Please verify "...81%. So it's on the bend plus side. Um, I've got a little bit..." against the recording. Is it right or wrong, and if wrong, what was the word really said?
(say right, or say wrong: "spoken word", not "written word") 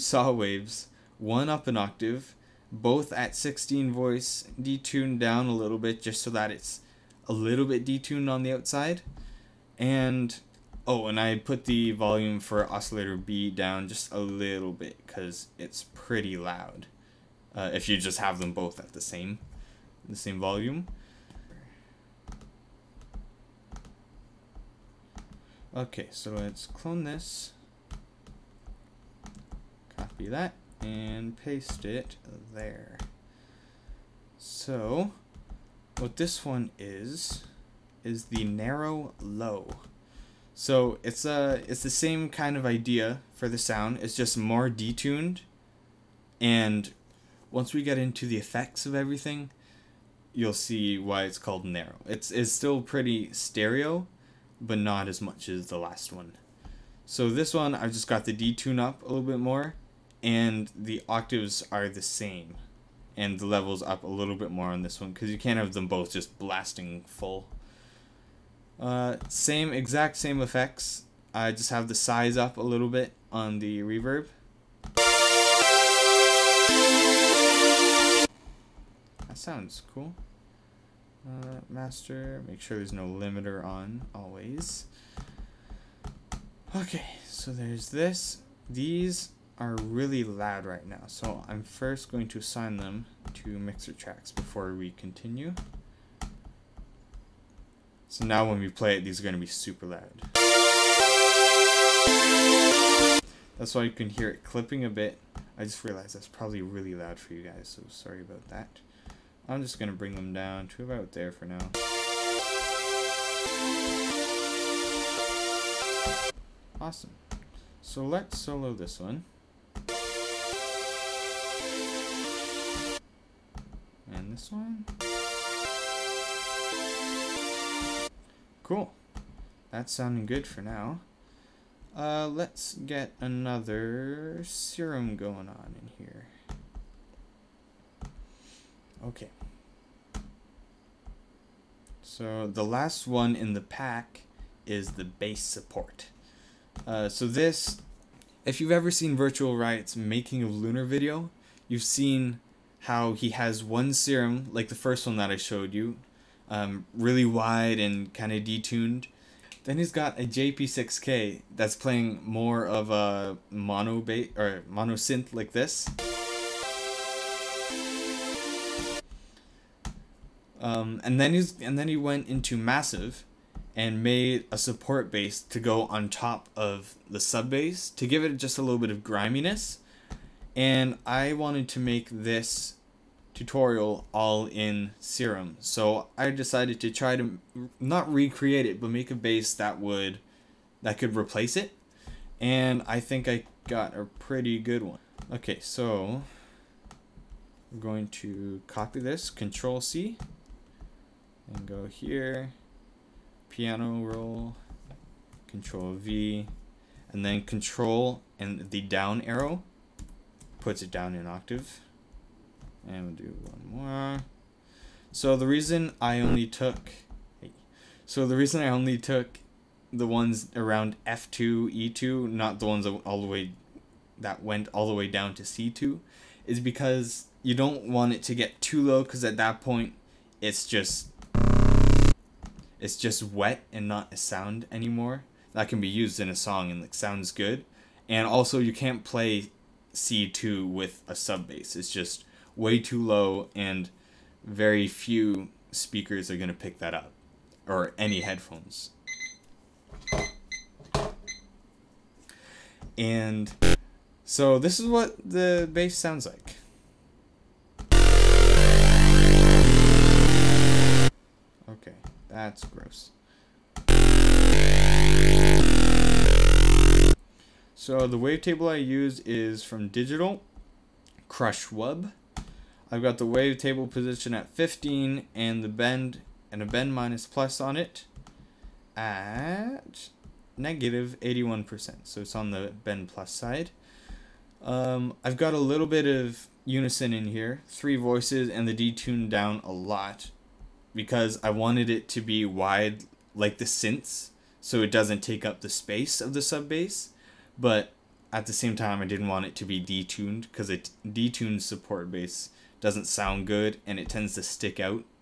right.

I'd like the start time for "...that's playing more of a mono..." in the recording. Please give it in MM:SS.
02:41.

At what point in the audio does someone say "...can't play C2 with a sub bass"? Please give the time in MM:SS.
03:58.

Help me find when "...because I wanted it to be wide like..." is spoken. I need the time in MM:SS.
04:50.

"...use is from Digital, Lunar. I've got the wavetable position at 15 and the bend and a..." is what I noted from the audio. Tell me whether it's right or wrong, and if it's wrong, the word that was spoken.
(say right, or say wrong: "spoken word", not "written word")
wrong: "CrushWeb", not "Lunar".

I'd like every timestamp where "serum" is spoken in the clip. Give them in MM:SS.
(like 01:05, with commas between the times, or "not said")
02:14, 02:33, 03:04.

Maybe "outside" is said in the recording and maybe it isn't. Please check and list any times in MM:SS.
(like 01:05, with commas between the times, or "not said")
00:08.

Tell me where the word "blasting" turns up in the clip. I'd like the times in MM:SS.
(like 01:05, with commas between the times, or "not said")
01:06.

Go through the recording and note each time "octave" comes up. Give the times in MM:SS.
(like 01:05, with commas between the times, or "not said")
00:01, 01:01, 03:31.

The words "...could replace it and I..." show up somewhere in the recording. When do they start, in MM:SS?
03:10.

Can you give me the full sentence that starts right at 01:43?
That's why you can hear it clipping a bit.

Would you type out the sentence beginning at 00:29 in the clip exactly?
Copy that and paste it there.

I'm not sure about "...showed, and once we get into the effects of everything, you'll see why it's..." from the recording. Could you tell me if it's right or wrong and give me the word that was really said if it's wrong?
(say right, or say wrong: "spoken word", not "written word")
wrong: "detuned", not "showed".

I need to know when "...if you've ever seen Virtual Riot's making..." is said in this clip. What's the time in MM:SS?
02:28.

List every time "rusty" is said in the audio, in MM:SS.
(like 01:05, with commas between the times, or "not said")
not said.